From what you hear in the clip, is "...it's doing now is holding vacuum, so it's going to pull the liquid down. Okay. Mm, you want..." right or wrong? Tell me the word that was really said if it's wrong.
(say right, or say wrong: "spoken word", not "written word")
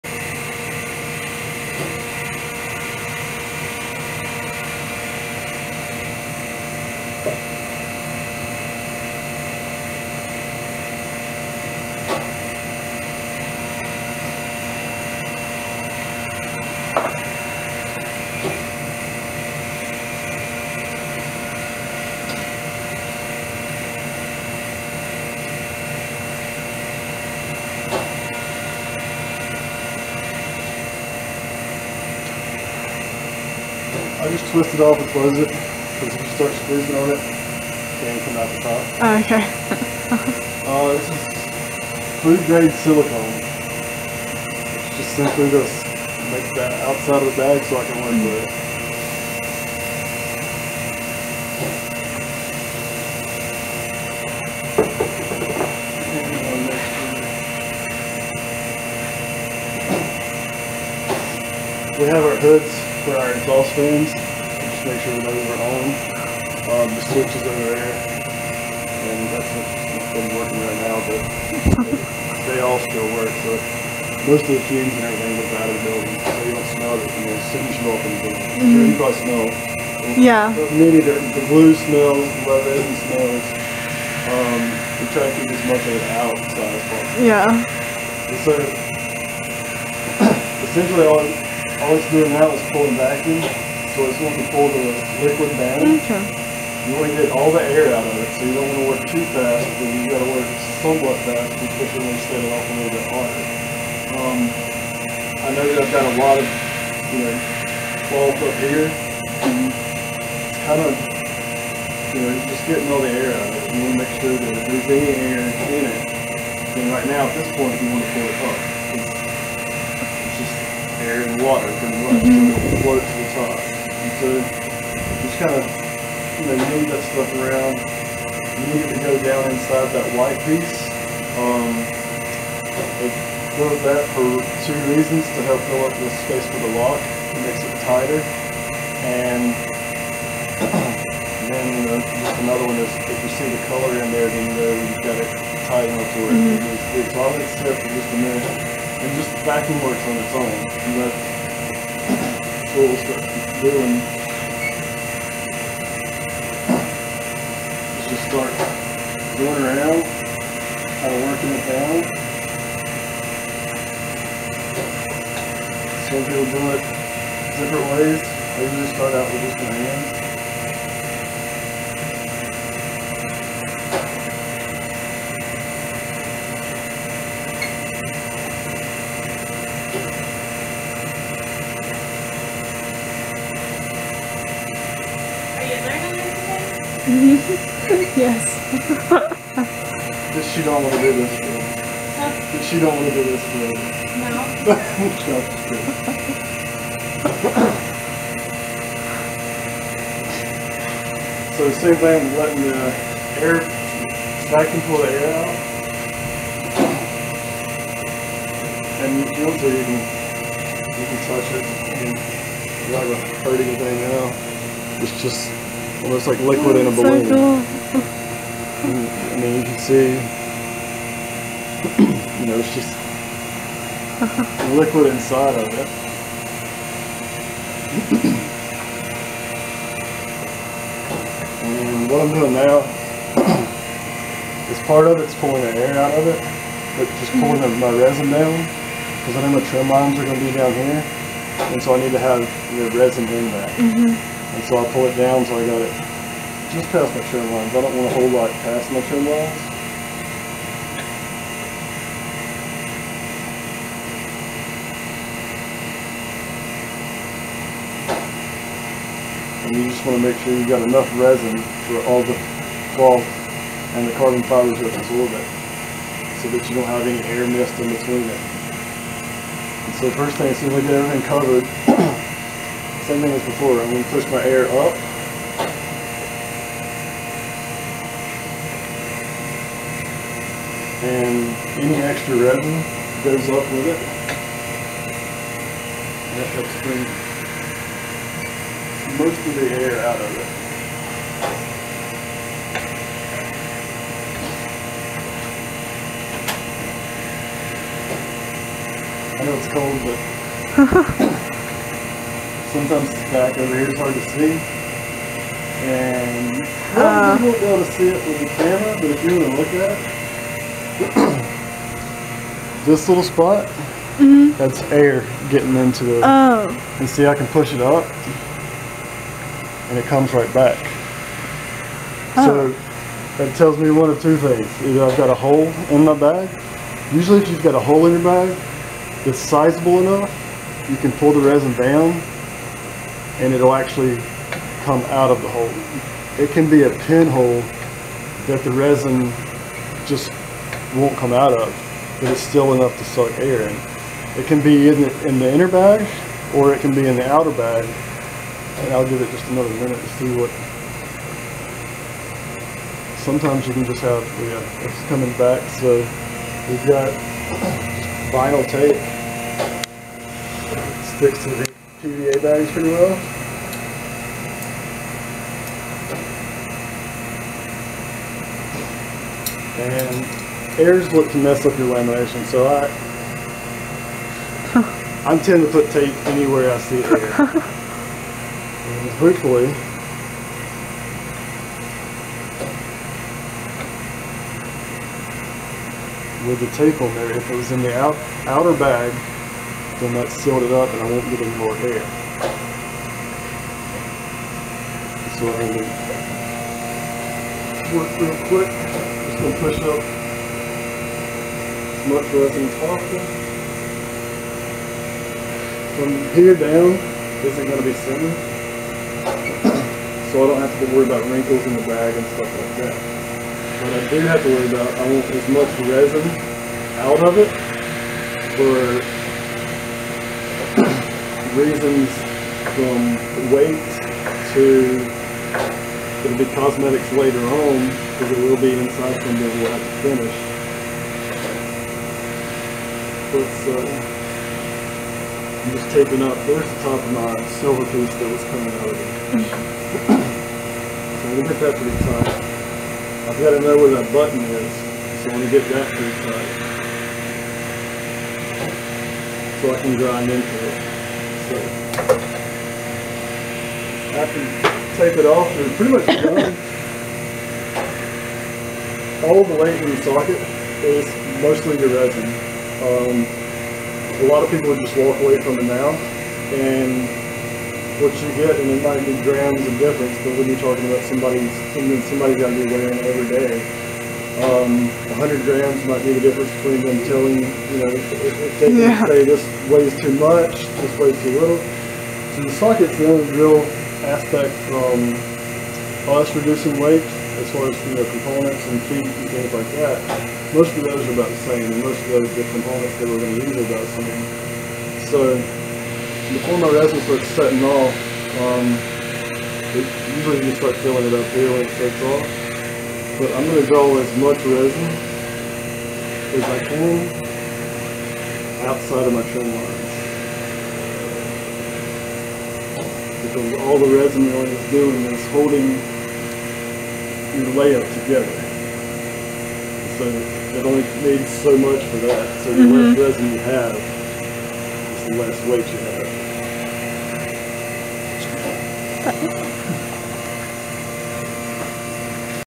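wrong: "pulling", not "holding".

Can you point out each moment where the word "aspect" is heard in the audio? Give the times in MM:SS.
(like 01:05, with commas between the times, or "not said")
08:04.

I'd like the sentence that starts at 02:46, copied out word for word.
So people do it different ways.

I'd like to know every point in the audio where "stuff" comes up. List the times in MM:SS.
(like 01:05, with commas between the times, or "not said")
02:07, 06:52.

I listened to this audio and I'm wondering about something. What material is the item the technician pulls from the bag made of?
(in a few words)
food grade silicone.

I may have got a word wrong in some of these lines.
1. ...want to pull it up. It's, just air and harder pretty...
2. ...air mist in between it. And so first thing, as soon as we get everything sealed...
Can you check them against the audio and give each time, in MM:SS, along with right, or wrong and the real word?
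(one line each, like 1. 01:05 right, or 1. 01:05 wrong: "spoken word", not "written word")
1. 01:57 wrong: "water", not "harder"
2. 04:27 wrong: "covered", not "sealed".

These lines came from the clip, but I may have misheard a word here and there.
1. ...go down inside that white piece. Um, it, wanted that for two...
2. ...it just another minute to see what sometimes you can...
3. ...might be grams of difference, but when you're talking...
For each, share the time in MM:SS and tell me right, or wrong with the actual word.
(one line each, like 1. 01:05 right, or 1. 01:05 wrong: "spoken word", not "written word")
1. 02:09 right
2. 05:49 right
3. 07:48 right.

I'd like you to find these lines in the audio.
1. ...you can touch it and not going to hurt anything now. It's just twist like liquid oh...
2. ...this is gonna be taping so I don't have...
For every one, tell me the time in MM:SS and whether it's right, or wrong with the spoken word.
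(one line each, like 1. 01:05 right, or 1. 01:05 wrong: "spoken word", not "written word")
1. 03:30 wrong: "almost", not "twist"
2. 06:47 wrong: "sitting", not "taping".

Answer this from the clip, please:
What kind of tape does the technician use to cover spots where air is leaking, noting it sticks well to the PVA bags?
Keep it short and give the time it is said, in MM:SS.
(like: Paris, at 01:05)
vinyl tape, at 05:58.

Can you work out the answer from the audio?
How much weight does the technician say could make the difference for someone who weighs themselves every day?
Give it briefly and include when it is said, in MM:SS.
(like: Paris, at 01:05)
100 grams, at 07:55.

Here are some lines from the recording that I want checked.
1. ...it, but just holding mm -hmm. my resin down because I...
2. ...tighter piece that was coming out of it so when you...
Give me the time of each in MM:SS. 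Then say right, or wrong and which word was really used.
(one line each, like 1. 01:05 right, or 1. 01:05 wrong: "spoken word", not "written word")
1. 03:56 wrong: "pulling", not "holding"
2. 07:17 wrong: "silver", not "tighter".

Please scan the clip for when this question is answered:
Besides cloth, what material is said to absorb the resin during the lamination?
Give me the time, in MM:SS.
04:24.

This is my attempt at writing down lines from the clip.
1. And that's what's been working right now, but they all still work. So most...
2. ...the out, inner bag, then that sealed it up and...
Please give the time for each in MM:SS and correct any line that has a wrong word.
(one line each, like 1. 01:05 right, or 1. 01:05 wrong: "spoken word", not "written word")
1. 01:09 right
2. 06:27 wrong: "outer", not "inner".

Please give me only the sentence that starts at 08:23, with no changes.
But I'm going to go as much resin as I can outside of my trim lines.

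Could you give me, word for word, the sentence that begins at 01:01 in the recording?
We have our hoods for our exhaust fans.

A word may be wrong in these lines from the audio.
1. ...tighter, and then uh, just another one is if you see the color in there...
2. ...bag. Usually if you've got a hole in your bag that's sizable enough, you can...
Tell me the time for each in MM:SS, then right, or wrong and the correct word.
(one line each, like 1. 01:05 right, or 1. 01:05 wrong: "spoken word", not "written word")
1. 02:17 right
2. 05:26 right.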